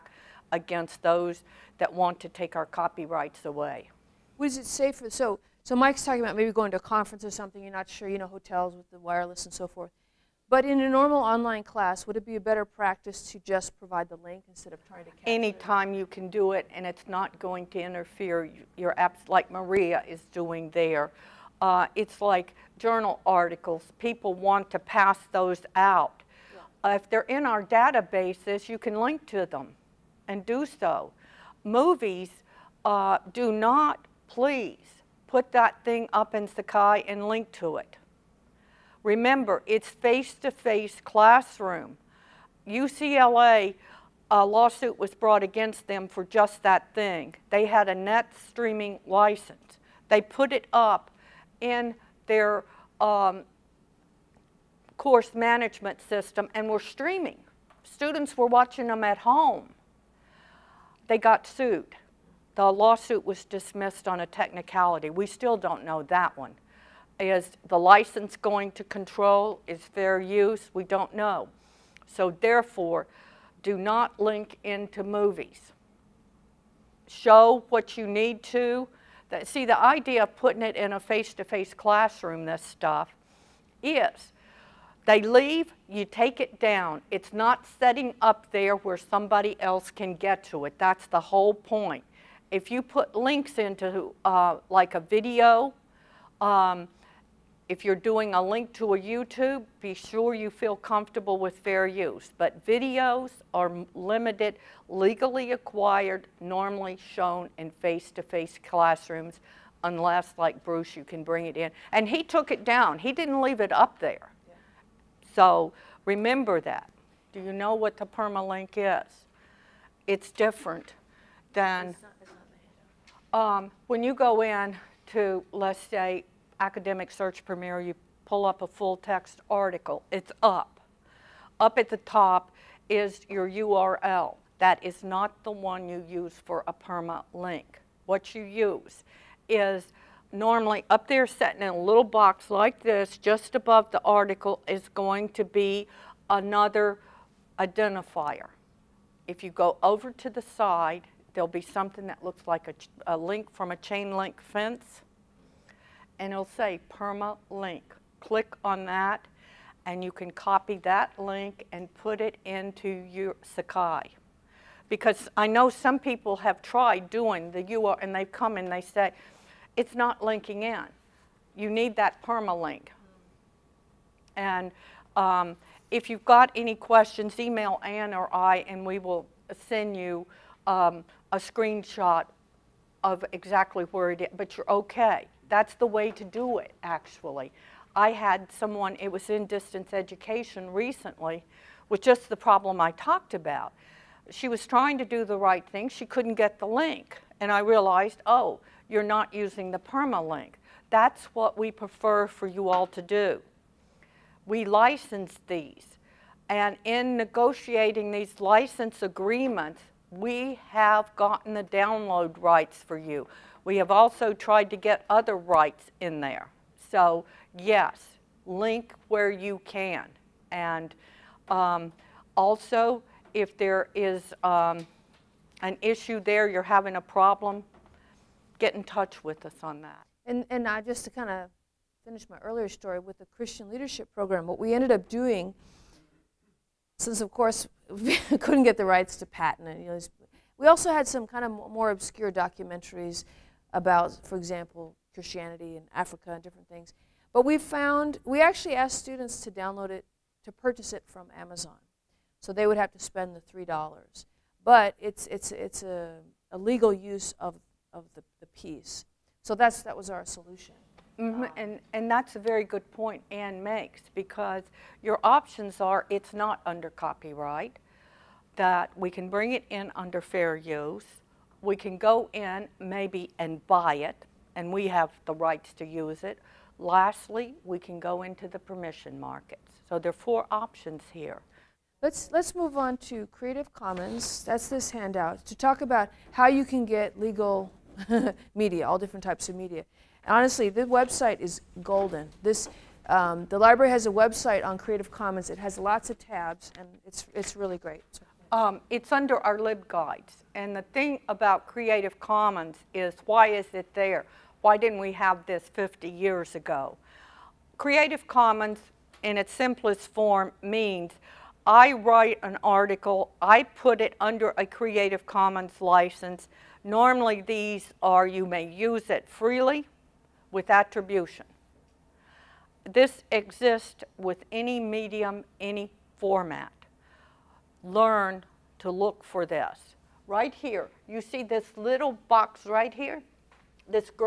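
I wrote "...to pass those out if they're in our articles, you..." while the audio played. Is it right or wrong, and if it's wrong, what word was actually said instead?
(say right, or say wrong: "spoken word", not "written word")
wrong: "databases", not "articles".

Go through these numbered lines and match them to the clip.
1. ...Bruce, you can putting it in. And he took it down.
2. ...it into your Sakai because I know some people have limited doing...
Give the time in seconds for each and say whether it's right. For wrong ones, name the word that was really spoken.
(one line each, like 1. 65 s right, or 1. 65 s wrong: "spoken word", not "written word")
1. 110 s wrong: "bring", not "putting"
2. 162 s wrong: "tried", not "limited".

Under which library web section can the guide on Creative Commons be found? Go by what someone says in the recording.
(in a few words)
LibGuides.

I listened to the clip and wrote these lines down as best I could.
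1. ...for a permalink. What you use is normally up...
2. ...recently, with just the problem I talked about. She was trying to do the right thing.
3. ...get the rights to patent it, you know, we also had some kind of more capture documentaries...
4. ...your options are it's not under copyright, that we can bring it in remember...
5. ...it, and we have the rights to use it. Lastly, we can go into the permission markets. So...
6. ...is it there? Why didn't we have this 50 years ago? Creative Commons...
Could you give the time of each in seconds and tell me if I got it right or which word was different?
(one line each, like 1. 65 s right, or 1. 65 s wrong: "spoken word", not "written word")
1. 136 s right
2. 190 s right
3. 238 s wrong: "obscure", not "capture"
4. 265 s wrong: "under", not "remember"
5. 274 s right
6. 303 s right.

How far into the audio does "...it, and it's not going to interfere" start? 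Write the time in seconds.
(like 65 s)
16 s.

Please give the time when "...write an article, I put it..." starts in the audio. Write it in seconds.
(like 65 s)
311 s.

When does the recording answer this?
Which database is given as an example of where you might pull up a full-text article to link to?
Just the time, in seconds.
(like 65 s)
126 s.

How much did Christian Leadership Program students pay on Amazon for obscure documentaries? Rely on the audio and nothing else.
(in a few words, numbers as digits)
$3.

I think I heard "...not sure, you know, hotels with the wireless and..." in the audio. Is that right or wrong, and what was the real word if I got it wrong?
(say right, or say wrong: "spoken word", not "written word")
right.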